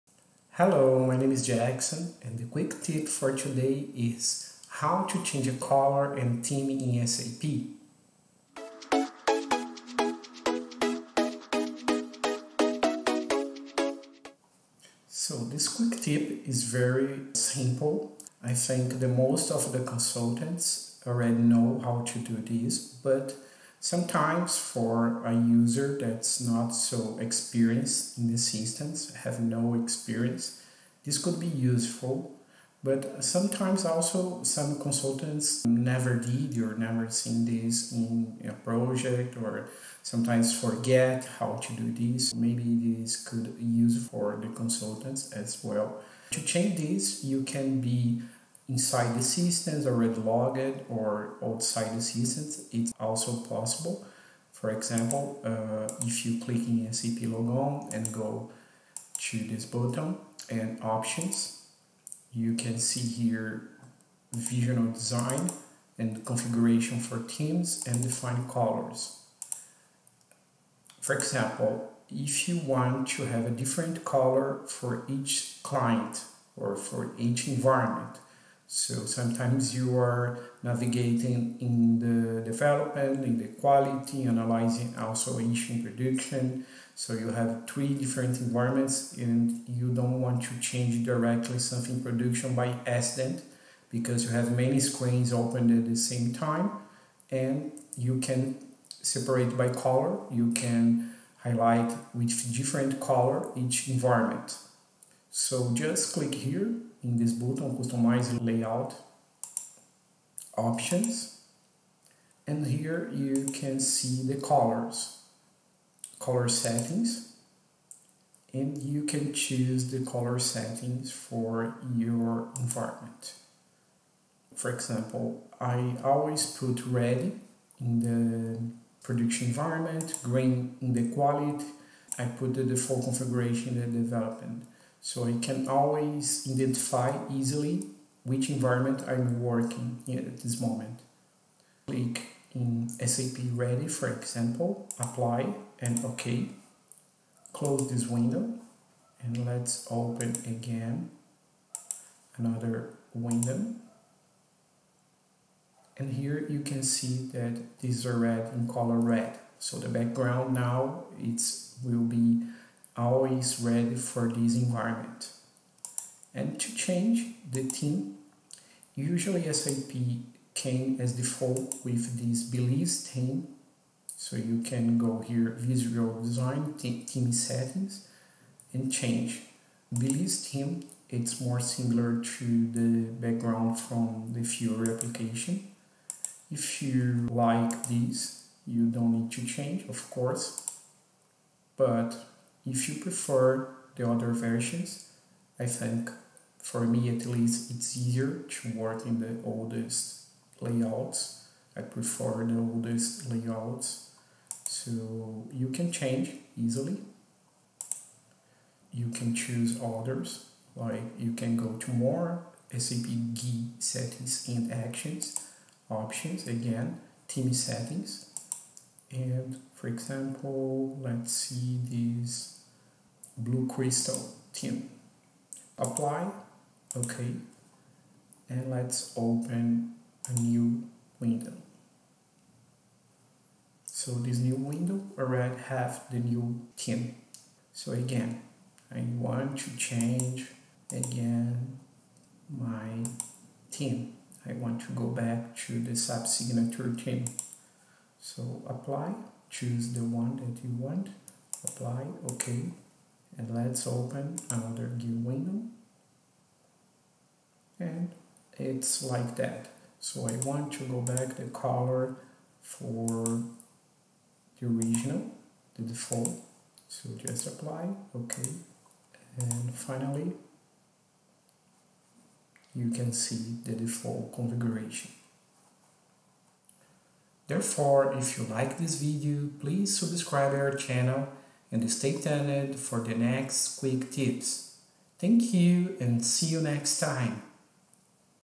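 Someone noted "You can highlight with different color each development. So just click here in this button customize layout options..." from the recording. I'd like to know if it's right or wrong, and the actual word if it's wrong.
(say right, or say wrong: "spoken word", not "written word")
wrong: "environment", not "development".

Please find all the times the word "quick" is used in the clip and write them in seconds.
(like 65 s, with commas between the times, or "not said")
2 s, 15 s, 283 s.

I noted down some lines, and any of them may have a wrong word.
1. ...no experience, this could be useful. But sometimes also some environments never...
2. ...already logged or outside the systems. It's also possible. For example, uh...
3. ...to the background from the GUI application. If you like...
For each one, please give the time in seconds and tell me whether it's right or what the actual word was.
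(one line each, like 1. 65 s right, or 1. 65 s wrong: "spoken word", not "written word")
1. 29 s wrong: "consultants", not "environments"
2. 49 s right
3. 182 s wrong: "Fiori", not "GUI".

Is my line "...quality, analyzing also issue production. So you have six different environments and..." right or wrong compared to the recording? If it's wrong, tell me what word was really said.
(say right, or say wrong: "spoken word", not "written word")
wrong: "three", not "six".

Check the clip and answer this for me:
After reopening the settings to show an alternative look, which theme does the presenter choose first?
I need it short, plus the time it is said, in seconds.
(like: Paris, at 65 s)
Blue Crystal, at 223 s.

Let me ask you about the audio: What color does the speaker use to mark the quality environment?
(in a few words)
Green.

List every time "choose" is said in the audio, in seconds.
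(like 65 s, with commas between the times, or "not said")
119 s, 209 s, 249 s.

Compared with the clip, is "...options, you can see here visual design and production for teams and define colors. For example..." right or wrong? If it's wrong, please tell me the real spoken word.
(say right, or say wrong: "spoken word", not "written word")
wrong: "configuration", not "production".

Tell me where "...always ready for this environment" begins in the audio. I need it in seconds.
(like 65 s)
162 s.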